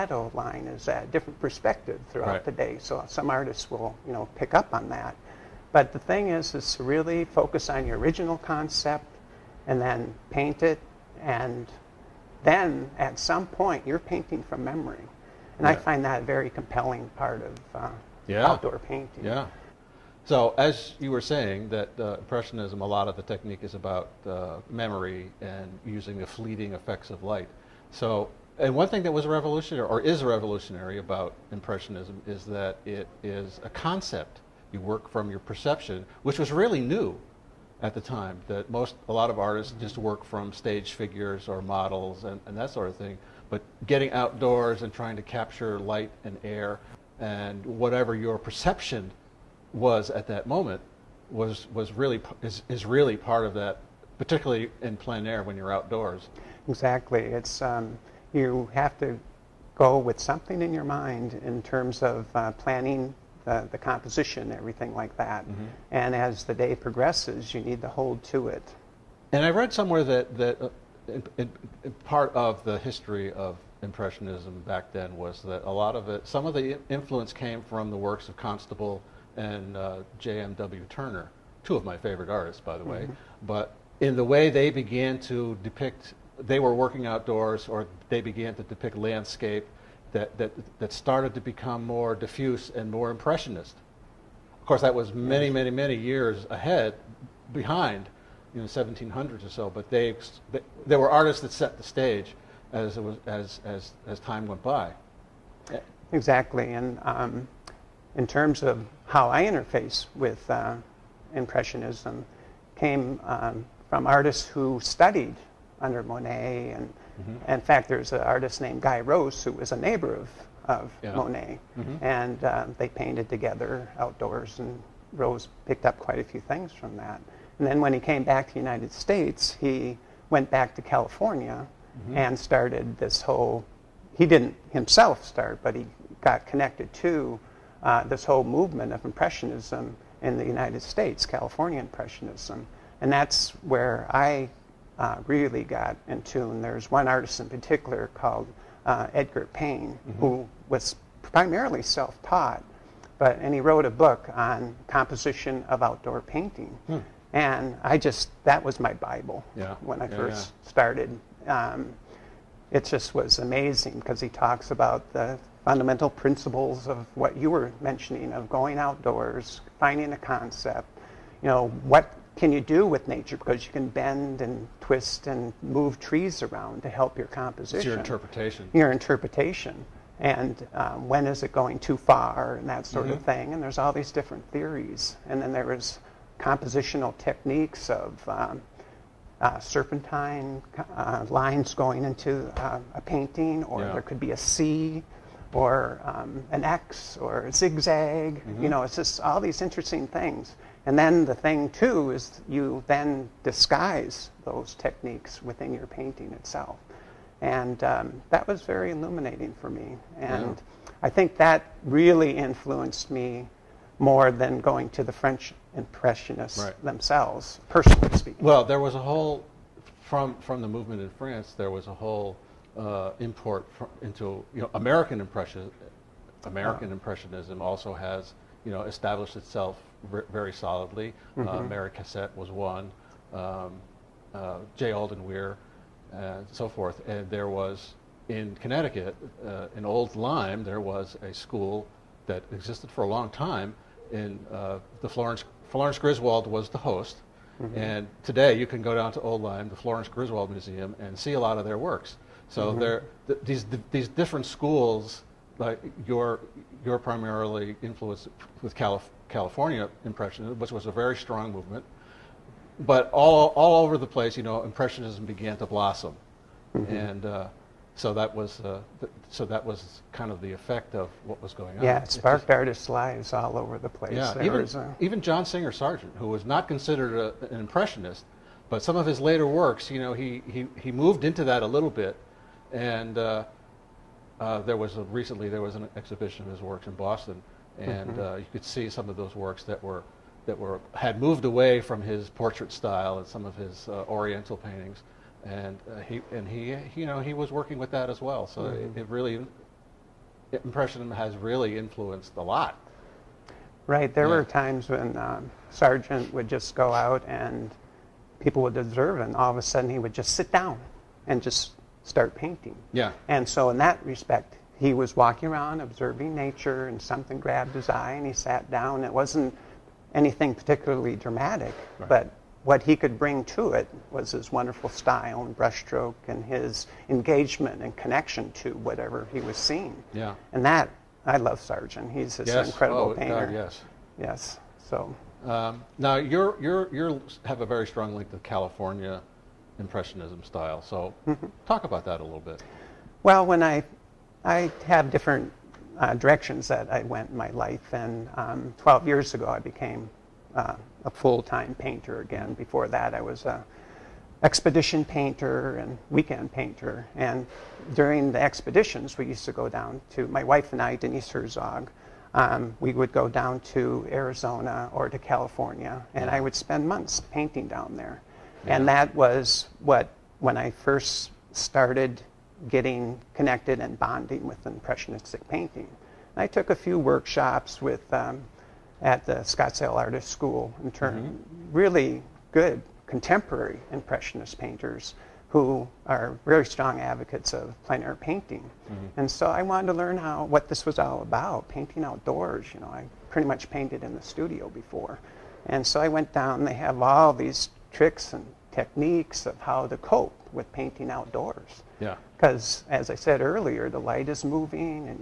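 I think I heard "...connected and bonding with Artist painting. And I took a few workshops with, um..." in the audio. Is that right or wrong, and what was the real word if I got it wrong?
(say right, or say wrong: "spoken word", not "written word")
wrong: "Impressionistic", not "Artist".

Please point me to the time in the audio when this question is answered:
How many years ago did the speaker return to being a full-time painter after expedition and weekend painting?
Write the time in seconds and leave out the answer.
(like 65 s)
348 s.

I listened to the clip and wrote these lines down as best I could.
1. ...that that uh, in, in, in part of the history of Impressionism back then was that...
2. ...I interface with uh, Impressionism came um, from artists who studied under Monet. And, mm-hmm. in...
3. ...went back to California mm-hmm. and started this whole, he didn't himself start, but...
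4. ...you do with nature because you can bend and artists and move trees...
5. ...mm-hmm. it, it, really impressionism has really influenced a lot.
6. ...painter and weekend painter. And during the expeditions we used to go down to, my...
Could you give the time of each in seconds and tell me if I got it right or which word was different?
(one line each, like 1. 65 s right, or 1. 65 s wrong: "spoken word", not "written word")
1. 70 s right
2. 109 s right
3. 130 s right
4. 172 s wrong: "twist", not "artists"
5. 298 s right
6. 355 s right.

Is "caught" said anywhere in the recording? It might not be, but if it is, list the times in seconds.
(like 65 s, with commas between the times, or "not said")
not said.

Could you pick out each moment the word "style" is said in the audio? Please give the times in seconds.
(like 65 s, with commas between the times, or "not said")
292 s, 324 s, 340 s.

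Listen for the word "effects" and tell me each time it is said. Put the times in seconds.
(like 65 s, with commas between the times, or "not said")
26 s, 270 s.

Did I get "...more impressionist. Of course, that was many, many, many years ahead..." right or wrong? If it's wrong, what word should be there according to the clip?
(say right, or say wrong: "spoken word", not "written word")
right.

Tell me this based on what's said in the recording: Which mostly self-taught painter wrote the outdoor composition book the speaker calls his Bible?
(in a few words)
Edgar Payne.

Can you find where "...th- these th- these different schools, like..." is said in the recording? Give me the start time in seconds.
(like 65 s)
253 s.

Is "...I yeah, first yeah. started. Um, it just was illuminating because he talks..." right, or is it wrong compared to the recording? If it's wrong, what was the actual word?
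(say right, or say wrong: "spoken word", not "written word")
wrong: "amazing", not "illuminating".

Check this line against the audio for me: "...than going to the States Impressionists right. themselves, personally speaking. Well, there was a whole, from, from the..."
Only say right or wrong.
wrong.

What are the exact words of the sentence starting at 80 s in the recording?
Turner, two of my favorite artists, by the way.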